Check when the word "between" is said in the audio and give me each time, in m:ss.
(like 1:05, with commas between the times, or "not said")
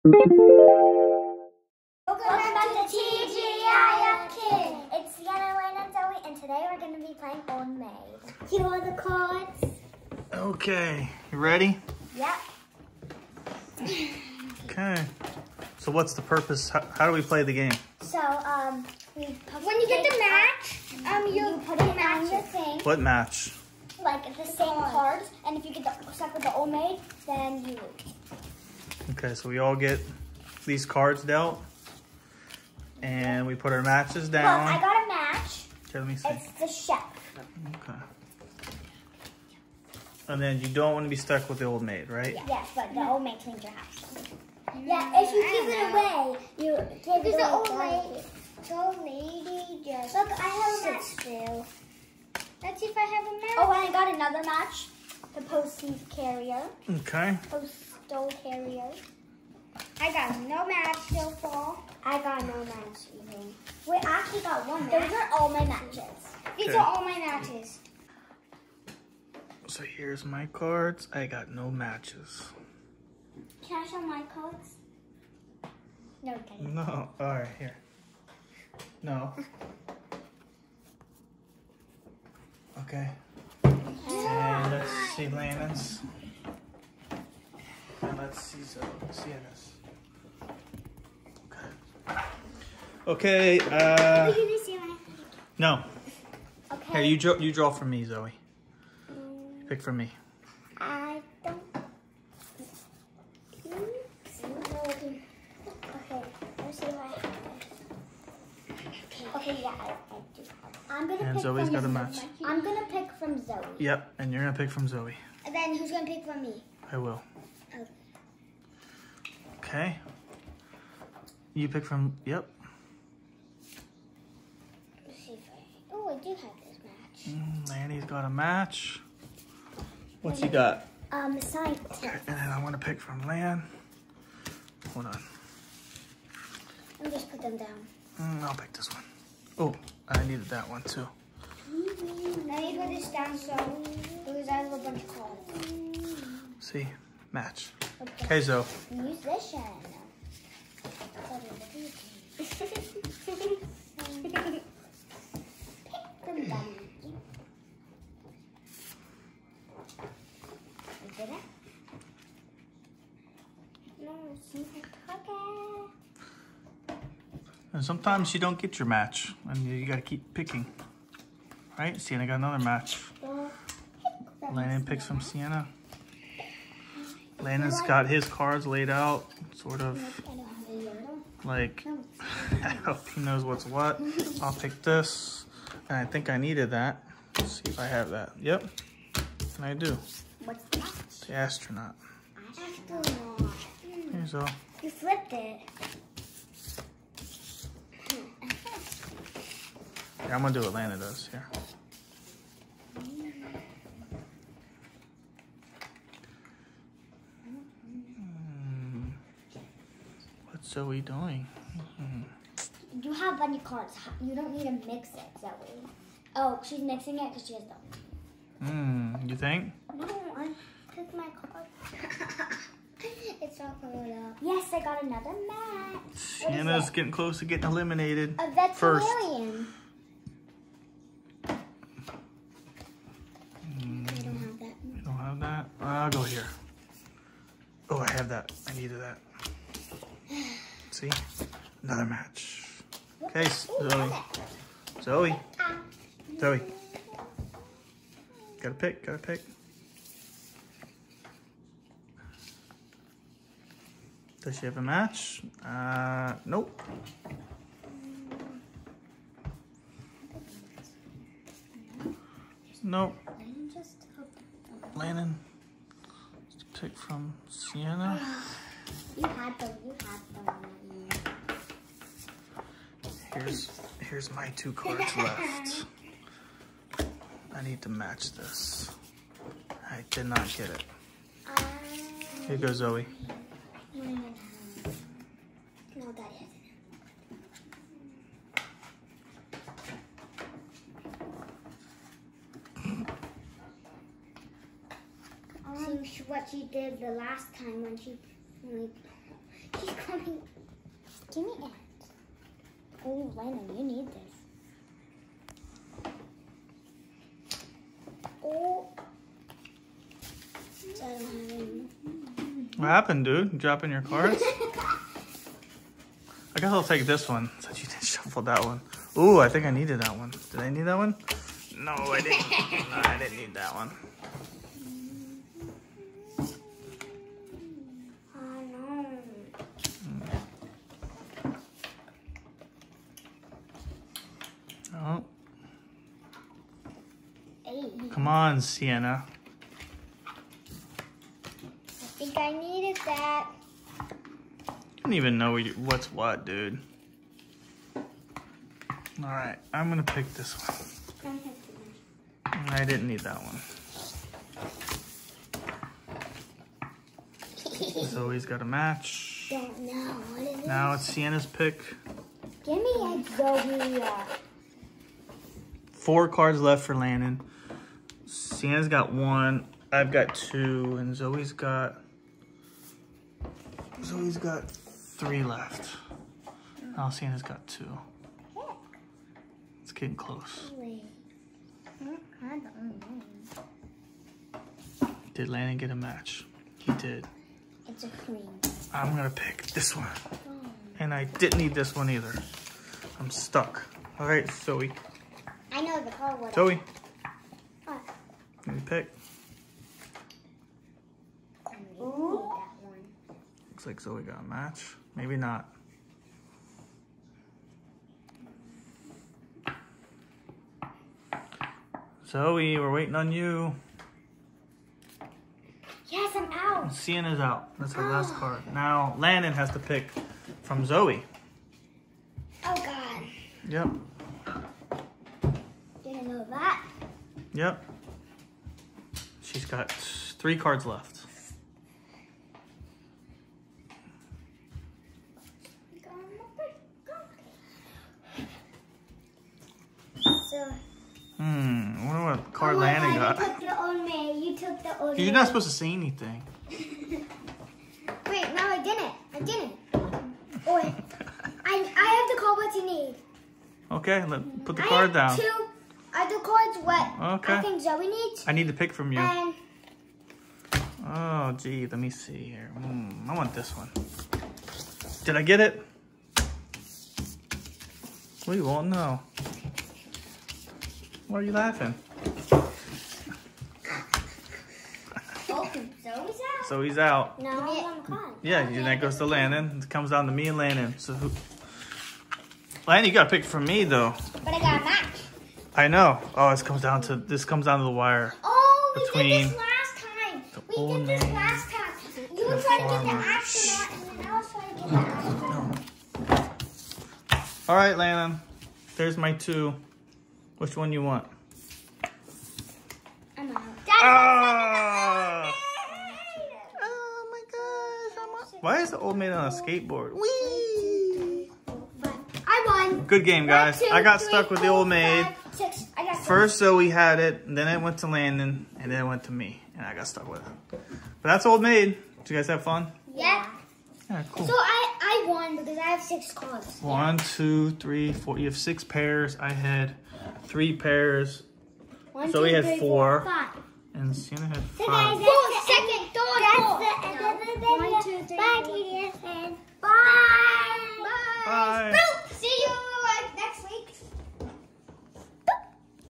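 8:09.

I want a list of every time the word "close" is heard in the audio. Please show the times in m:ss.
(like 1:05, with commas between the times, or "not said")
3:47, 6:20.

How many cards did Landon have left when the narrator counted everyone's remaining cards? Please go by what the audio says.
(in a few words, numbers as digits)
4.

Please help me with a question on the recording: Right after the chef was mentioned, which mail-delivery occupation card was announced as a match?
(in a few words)
Postie carrier.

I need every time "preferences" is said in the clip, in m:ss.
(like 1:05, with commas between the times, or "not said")
not said.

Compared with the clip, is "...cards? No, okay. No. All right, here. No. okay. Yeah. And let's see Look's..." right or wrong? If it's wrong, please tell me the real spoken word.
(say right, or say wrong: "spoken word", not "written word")
wrong: "Landon", not "Look".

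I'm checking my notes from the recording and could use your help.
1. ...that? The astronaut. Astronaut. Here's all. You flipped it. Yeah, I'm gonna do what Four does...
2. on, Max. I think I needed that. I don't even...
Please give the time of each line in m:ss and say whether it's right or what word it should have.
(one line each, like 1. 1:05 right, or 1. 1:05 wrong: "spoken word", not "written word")
1. 3:10 wrong: "Lana", not "Four"
2. 5:38 wrong: "Sienna", not "Max".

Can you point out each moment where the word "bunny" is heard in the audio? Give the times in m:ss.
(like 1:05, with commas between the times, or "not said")
3:33.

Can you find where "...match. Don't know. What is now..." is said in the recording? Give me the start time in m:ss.
5:58.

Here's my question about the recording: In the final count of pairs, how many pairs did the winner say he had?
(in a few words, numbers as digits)
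6.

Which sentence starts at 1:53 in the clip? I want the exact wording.
Yep, and you're gonna pick from Zoe.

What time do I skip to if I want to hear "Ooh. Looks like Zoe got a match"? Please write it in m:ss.
6:41.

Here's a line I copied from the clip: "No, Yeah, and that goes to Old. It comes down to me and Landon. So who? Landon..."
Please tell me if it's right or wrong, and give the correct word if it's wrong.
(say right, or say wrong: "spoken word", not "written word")
wrong: "Landon", not "Old".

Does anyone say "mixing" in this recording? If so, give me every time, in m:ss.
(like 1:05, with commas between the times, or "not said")
3:36.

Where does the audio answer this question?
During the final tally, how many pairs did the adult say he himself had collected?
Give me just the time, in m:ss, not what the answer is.
8:49.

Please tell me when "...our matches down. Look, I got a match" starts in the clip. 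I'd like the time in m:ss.
0:33.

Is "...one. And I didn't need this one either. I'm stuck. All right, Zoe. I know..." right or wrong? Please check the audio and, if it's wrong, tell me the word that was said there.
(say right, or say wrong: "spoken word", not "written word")
right.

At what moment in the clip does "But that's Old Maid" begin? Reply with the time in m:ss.
8:40.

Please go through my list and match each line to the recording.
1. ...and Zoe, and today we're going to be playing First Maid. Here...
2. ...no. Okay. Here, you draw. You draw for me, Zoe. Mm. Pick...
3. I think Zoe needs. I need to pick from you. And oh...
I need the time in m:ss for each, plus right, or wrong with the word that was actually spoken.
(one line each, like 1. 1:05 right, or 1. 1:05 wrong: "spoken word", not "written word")
1. 0:05 wrong: "Old", not "First"
2. 1:35 right
3. 7:37 right.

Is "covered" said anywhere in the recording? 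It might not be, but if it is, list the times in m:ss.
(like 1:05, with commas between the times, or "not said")
3:43.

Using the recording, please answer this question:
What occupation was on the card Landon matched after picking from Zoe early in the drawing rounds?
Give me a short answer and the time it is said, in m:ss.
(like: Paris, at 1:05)
Scientist, at 2:11.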